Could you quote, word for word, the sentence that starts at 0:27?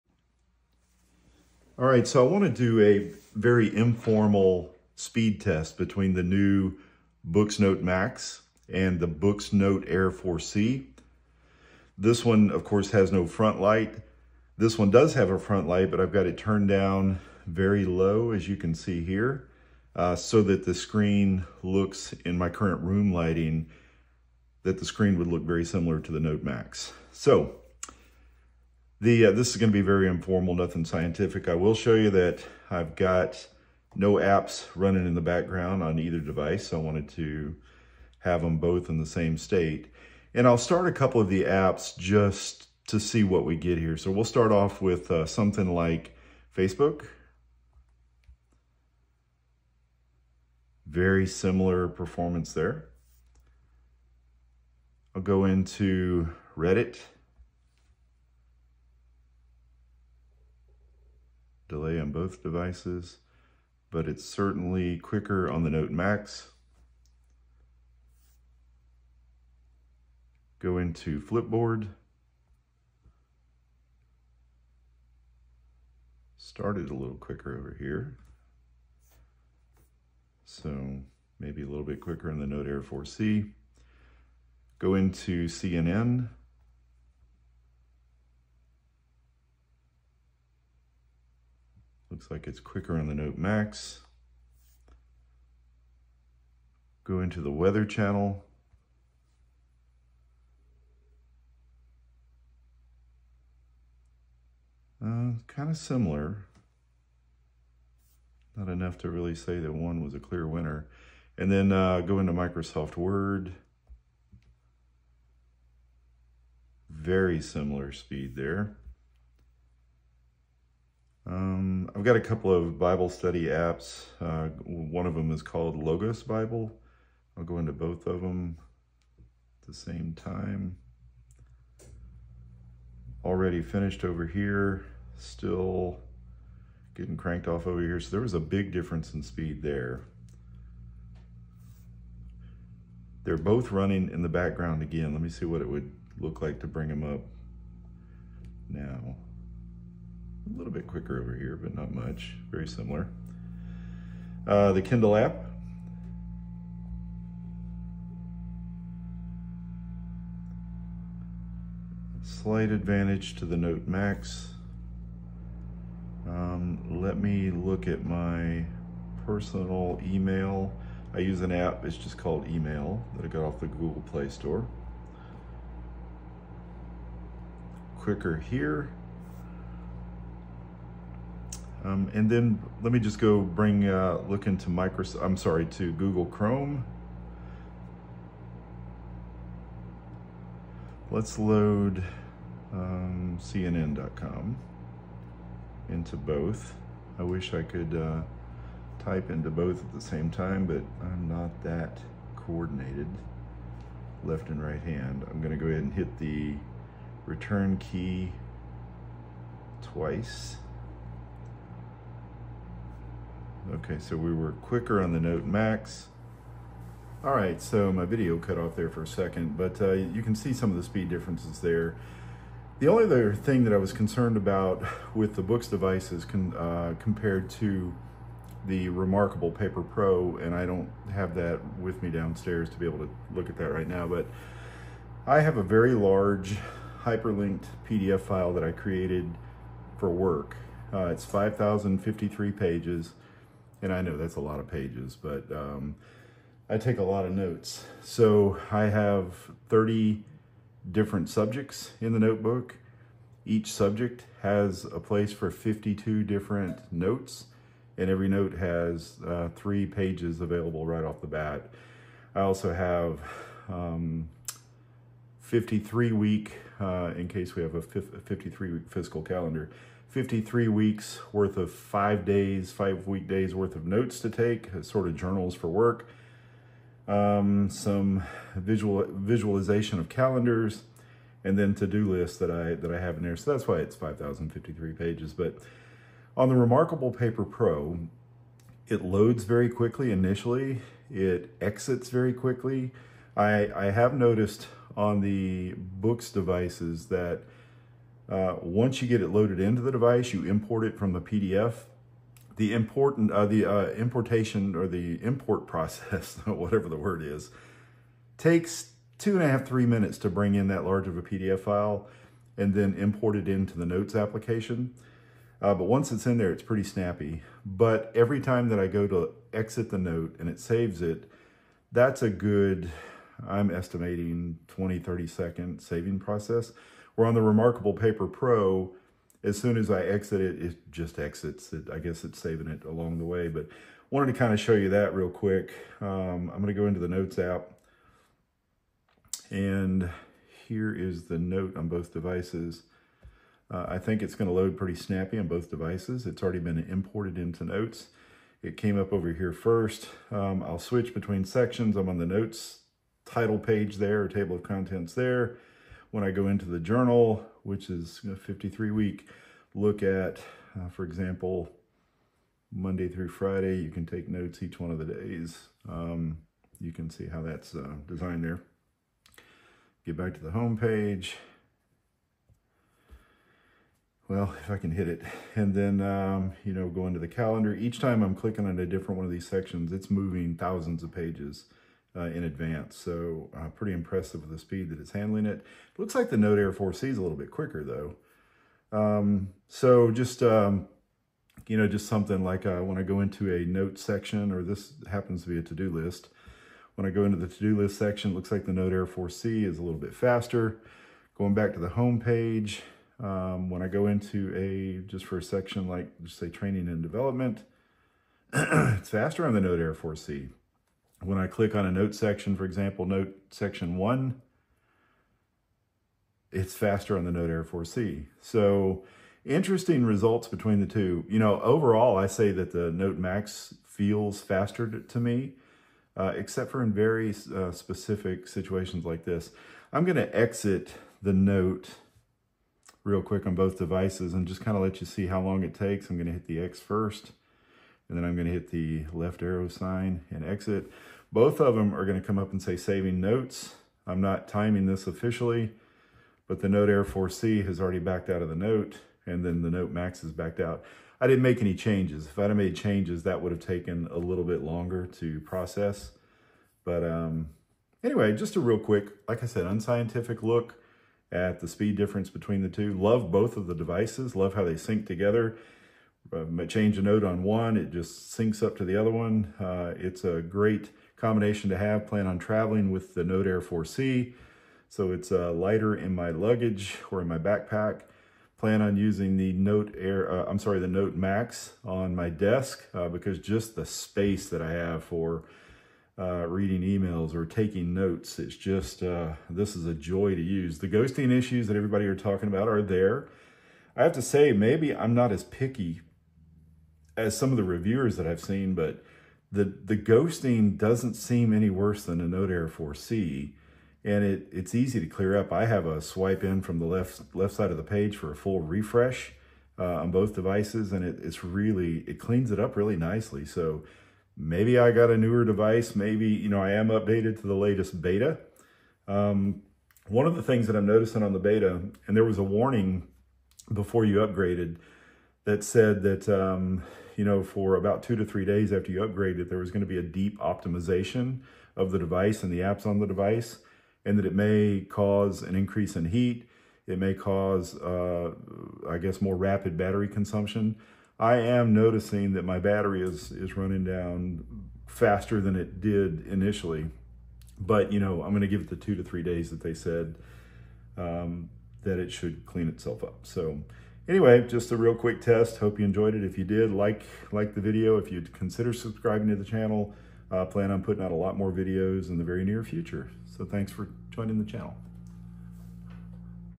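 So the uh, This is going to be very informal, nothing scientific.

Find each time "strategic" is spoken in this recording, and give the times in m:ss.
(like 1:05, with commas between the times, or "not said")
not said.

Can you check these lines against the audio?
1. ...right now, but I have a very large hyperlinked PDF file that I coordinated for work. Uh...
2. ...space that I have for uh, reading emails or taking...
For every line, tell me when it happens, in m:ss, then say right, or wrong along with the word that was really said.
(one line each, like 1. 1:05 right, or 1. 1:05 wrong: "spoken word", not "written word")
1. 3:53 wrong: "created", not "coordinated"
2. 8:03 right.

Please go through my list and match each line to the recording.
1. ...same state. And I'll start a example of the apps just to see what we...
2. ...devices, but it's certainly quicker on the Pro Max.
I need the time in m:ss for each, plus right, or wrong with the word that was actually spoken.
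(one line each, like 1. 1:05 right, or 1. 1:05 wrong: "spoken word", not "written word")
1. 0:39 wrong: "couple", not "example"
2. 1:02 wrong: "Note", not "Pro".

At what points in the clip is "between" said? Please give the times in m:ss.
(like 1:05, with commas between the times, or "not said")
0:05, 5:51, 7:00, 7:42.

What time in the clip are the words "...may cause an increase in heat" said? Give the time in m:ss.
8:54.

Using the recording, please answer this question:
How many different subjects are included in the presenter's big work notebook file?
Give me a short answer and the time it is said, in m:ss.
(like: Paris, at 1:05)
30, at 4:09.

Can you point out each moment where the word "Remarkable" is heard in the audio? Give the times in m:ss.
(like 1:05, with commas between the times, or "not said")
3:48, 4:46, 5:27.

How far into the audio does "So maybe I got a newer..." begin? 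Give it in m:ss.
8:33.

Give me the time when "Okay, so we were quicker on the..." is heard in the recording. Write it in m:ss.
3:33.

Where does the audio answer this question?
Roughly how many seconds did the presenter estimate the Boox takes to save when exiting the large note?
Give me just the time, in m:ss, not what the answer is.
5:24.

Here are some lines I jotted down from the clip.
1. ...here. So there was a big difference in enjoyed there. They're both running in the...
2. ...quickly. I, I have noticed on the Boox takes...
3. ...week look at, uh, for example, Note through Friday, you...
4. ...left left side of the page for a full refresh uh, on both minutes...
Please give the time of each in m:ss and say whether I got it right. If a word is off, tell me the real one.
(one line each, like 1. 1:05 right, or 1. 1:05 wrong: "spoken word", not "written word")
1. 2:17 wrong: "speed", not "enjoyed"
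2. 4:52 wrong: "devices", not "takes"
3. 5:58 wrong: "Monday", not "Note"
4. 8:26 wrong: "devices", not "minutes".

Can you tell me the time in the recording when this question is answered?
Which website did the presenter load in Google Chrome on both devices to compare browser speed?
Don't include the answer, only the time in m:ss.
3:13.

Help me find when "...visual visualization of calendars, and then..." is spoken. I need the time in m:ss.
4:38.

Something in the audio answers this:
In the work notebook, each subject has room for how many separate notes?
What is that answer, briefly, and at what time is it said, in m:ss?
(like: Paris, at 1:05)
52, at 4:15.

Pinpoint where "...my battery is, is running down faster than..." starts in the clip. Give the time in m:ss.
9:02.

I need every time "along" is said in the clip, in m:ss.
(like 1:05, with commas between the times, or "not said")
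5:32.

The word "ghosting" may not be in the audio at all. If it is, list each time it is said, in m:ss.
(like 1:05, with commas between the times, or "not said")
8:10, 8:19.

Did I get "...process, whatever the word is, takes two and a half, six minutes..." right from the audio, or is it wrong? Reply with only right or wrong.
wrong.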